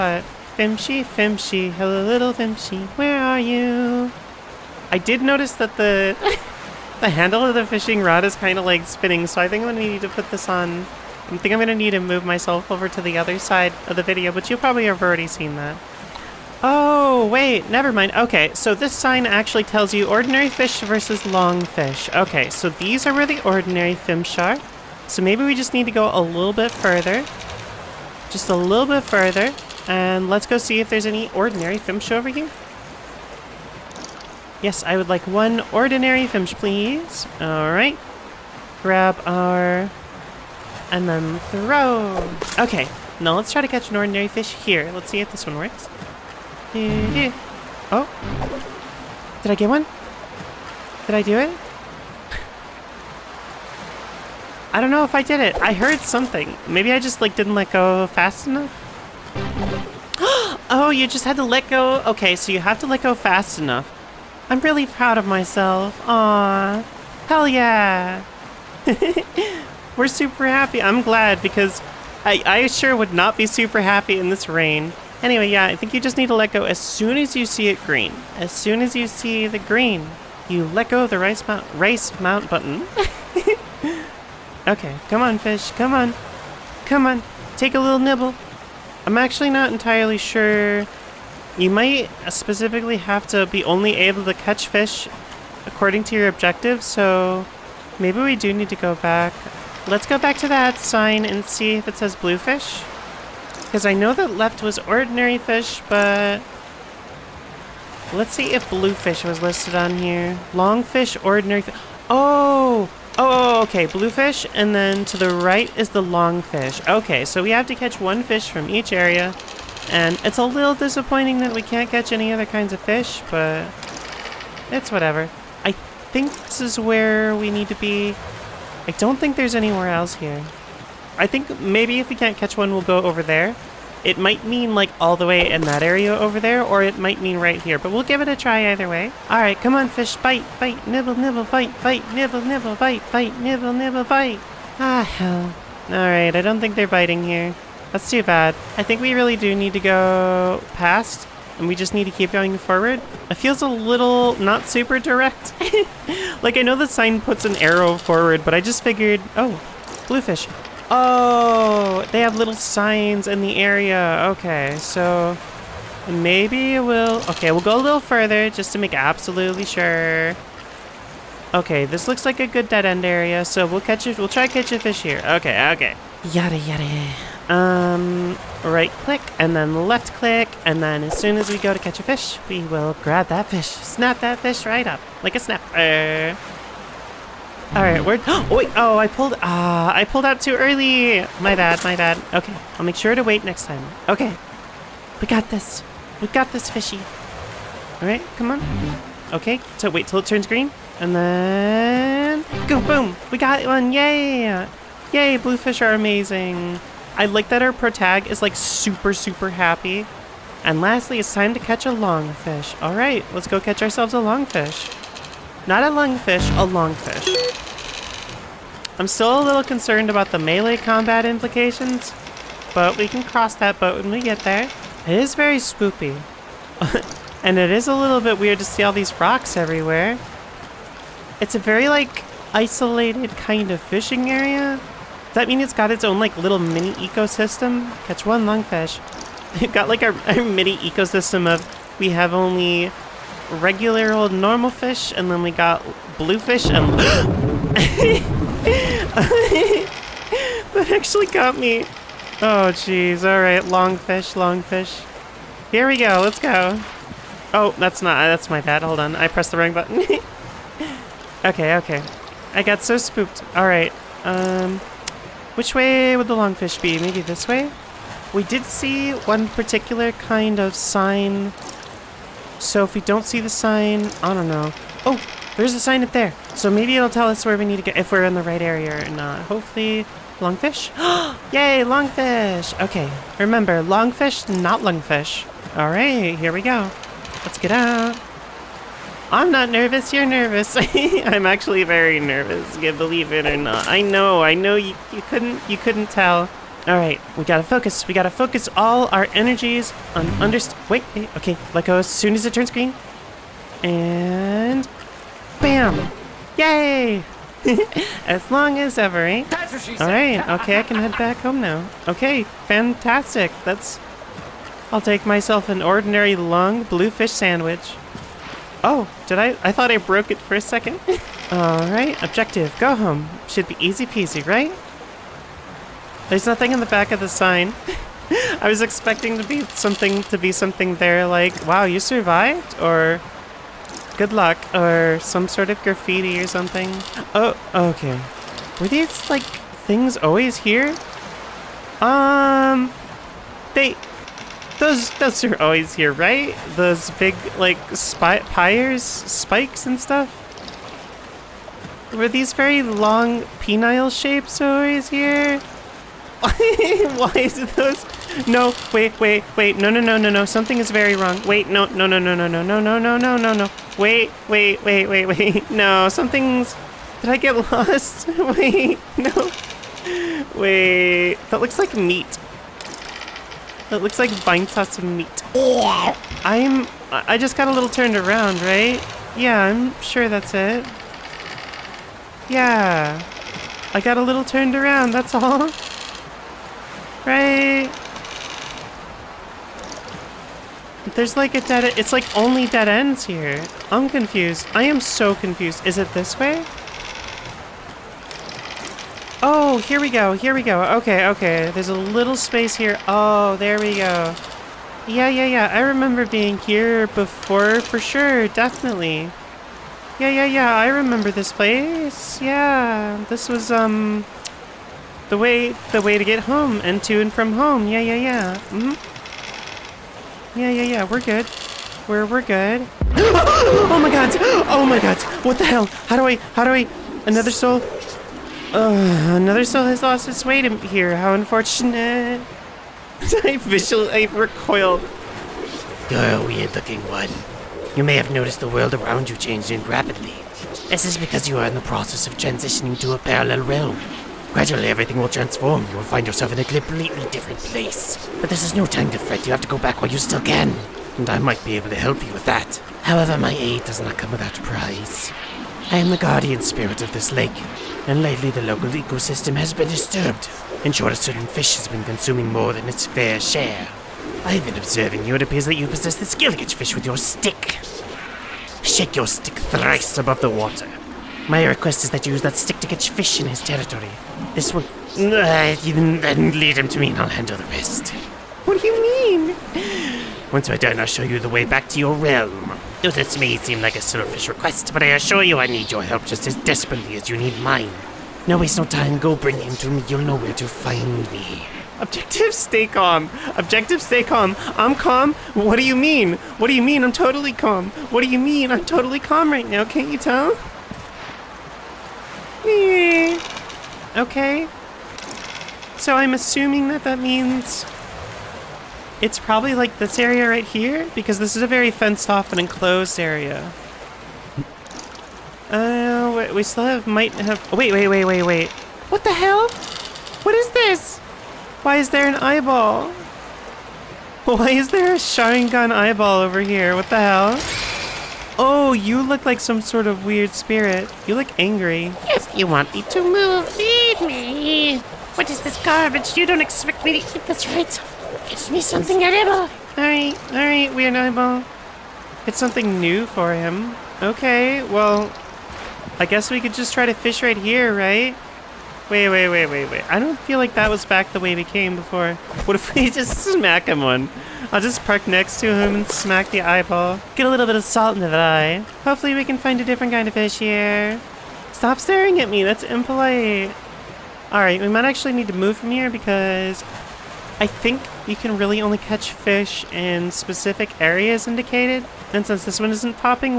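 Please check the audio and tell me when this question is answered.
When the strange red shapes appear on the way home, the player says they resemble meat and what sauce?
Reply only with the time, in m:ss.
6:14.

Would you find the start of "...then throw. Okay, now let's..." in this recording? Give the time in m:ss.
0:41.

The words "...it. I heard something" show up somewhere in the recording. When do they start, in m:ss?
0:55.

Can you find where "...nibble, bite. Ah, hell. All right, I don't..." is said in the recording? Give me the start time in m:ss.
2:23.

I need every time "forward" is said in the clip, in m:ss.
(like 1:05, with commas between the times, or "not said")
2:32, 2:37.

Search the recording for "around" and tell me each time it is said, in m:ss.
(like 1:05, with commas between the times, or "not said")
6:18, 6:24, 7:18.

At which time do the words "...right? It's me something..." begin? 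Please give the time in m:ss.
8:57.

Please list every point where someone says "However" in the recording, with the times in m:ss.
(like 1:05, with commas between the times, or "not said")
7:33.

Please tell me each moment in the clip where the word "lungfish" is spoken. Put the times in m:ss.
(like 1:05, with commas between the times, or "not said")
3:35, 3:58, 4:44.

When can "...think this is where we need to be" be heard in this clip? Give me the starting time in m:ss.
2:05.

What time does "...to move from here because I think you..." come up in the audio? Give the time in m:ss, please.
9:25.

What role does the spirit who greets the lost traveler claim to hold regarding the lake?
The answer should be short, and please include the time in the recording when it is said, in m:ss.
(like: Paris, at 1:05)
Guardian spirit, at 7:36.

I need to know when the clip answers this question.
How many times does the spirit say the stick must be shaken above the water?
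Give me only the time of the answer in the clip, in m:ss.
7:49.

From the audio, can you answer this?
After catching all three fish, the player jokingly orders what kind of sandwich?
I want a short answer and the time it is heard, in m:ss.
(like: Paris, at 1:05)
Ordinary long bluefish sandwich, at 5:15.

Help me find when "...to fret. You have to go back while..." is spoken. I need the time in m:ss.
7:29.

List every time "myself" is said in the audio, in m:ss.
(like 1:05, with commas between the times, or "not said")
0:12, 1:05, 5:15.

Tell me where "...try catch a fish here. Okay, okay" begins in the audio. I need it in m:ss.
2:54.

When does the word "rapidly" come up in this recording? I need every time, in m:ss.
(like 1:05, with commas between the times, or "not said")
7:19.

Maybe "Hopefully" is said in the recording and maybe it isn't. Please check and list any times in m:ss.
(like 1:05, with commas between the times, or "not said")
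4:39, 9:19.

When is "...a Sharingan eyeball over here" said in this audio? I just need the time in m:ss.
8:45.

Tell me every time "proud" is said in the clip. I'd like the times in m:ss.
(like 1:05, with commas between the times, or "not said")
1:04.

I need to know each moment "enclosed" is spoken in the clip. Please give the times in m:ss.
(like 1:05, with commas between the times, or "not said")
8:32.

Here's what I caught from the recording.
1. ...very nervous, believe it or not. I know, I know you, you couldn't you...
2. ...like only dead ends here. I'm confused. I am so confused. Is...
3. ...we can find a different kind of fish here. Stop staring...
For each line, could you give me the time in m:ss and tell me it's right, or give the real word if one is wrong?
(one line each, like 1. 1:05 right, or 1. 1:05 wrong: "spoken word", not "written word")
1. 4:51 right
2. 6:32 right
3. 9:19 right.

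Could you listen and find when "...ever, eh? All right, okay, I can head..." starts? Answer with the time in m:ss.
5:08.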